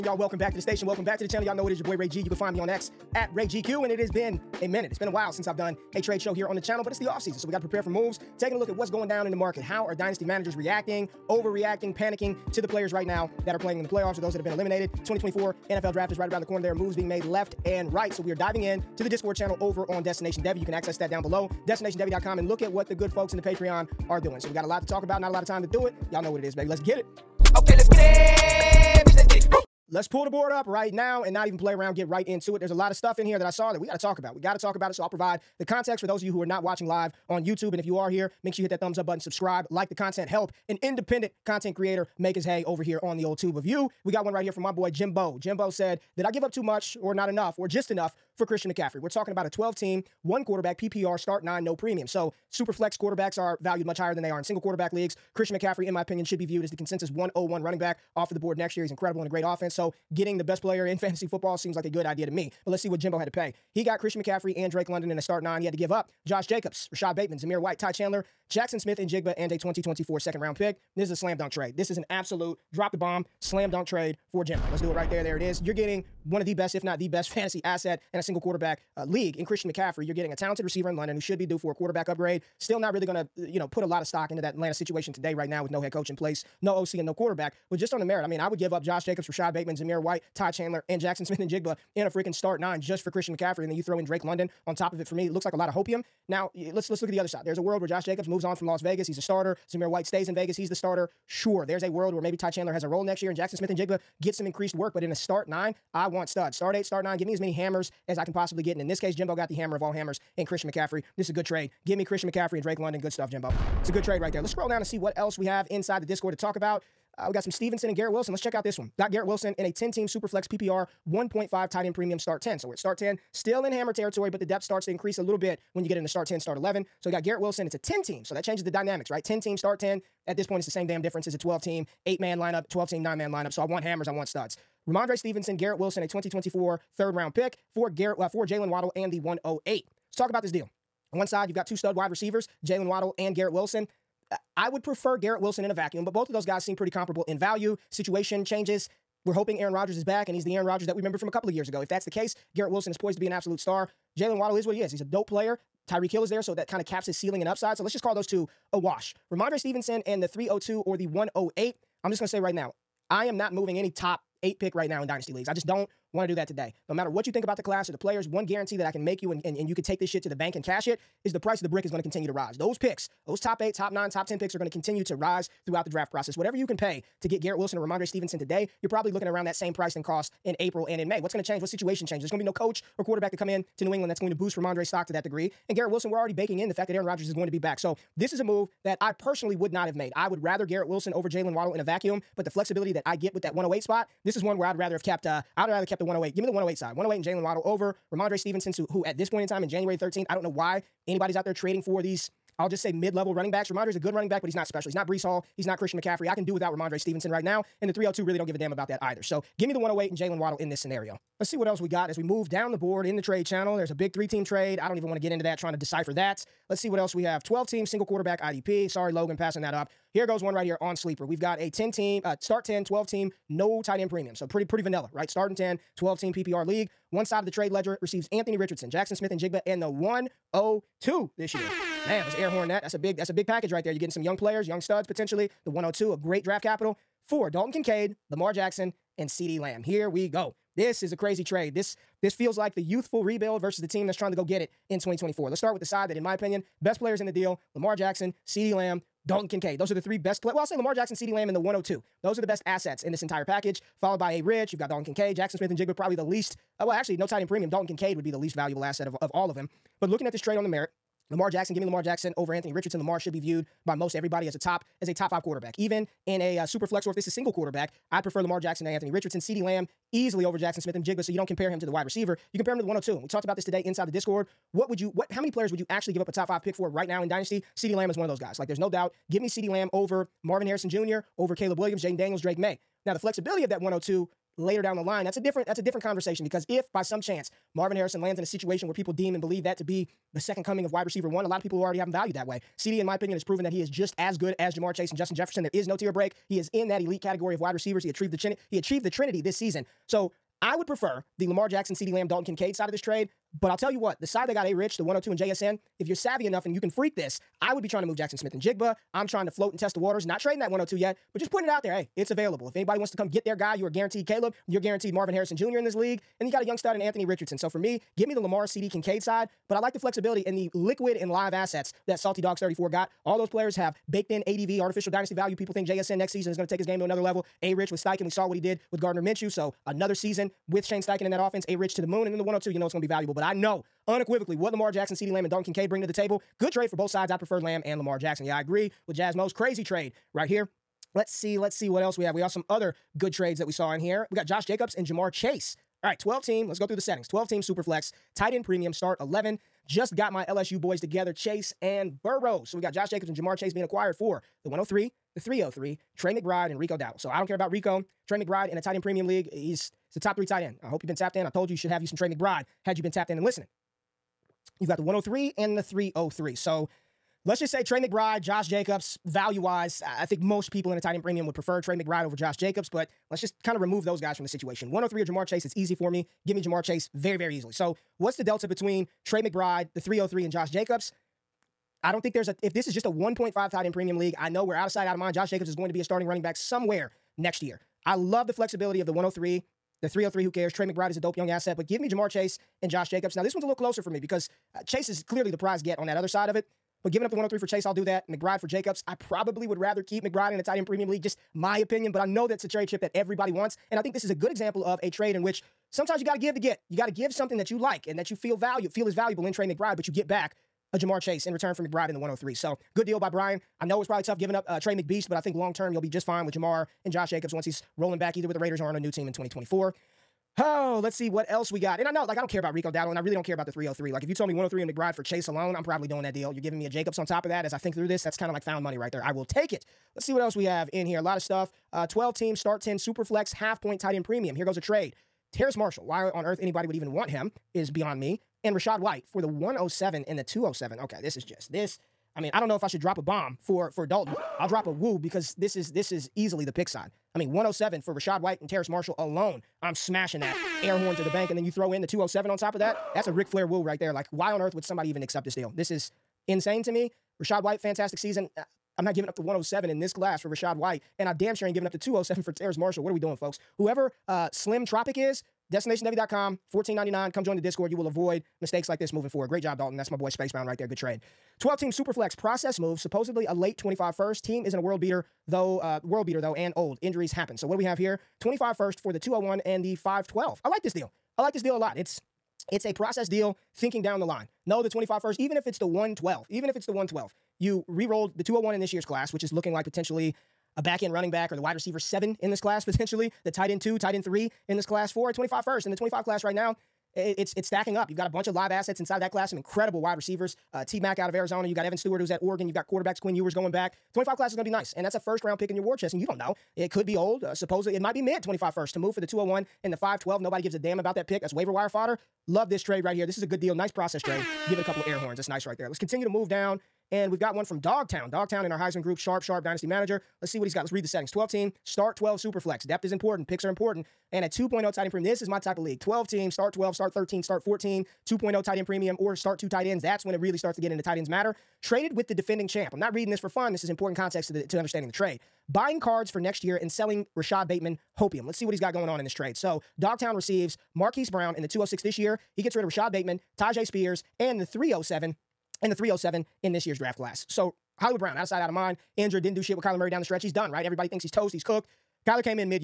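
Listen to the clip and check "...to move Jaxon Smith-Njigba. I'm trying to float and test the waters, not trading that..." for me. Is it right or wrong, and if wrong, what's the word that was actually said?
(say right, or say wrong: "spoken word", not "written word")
right.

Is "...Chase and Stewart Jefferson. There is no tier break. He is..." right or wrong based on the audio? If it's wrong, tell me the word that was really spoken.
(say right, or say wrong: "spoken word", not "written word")
wrong: "Justin", not "Stewart".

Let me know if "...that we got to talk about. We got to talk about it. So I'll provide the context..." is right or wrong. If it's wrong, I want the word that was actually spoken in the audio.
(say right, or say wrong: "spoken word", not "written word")
right.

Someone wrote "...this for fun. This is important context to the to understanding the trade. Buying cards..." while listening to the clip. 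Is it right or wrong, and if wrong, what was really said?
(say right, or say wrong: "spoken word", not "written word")
right.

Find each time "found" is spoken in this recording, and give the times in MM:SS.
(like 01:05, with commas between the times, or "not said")
07:08.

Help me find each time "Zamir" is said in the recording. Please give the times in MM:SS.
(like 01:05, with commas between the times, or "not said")
01:07, 01:29, 01:39.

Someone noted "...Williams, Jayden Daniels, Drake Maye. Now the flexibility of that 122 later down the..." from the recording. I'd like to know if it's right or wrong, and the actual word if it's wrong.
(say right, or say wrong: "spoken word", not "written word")
wrong: "102", not "122".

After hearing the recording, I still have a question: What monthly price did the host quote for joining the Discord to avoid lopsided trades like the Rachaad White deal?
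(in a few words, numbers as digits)
$14.99.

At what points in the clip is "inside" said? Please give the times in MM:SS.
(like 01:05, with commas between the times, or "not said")
01:55, 04:33, 08:18.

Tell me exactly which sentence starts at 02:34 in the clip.
Jaylen Waddle is what he is.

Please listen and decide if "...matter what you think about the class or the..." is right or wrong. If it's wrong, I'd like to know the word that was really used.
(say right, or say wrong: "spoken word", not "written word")
right.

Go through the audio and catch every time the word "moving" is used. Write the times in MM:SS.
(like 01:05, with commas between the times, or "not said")
02:43, 07:49.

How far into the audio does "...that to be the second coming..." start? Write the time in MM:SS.
04:49.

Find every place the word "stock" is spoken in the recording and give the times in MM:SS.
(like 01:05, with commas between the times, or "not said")
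01:24, 03:04.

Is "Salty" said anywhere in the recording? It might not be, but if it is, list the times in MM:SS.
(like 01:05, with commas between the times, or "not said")
05:22.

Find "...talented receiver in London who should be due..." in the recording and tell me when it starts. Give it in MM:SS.
01:20.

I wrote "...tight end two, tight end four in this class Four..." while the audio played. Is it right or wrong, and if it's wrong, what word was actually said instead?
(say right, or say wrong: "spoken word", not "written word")
wrong: "three", not "four".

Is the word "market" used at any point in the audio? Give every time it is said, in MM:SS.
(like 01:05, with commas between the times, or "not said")
00:09.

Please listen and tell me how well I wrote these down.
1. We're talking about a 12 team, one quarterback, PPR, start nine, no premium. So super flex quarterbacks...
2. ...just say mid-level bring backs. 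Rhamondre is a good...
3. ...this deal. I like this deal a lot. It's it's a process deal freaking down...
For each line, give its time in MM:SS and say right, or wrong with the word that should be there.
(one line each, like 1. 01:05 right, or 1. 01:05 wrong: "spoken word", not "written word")
1. 00:48 right
2. 03:22 wrong: "running", not "bring"
3. 08:00 wrong: "thinking", not "freaking".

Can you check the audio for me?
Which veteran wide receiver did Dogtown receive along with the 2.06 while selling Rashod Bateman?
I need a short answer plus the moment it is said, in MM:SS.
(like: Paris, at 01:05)
Marquise Brown, at 09:00.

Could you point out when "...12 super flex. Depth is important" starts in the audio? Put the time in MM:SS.
08:42.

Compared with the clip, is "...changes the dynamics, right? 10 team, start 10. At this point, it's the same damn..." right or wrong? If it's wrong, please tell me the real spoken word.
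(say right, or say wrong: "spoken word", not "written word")
right.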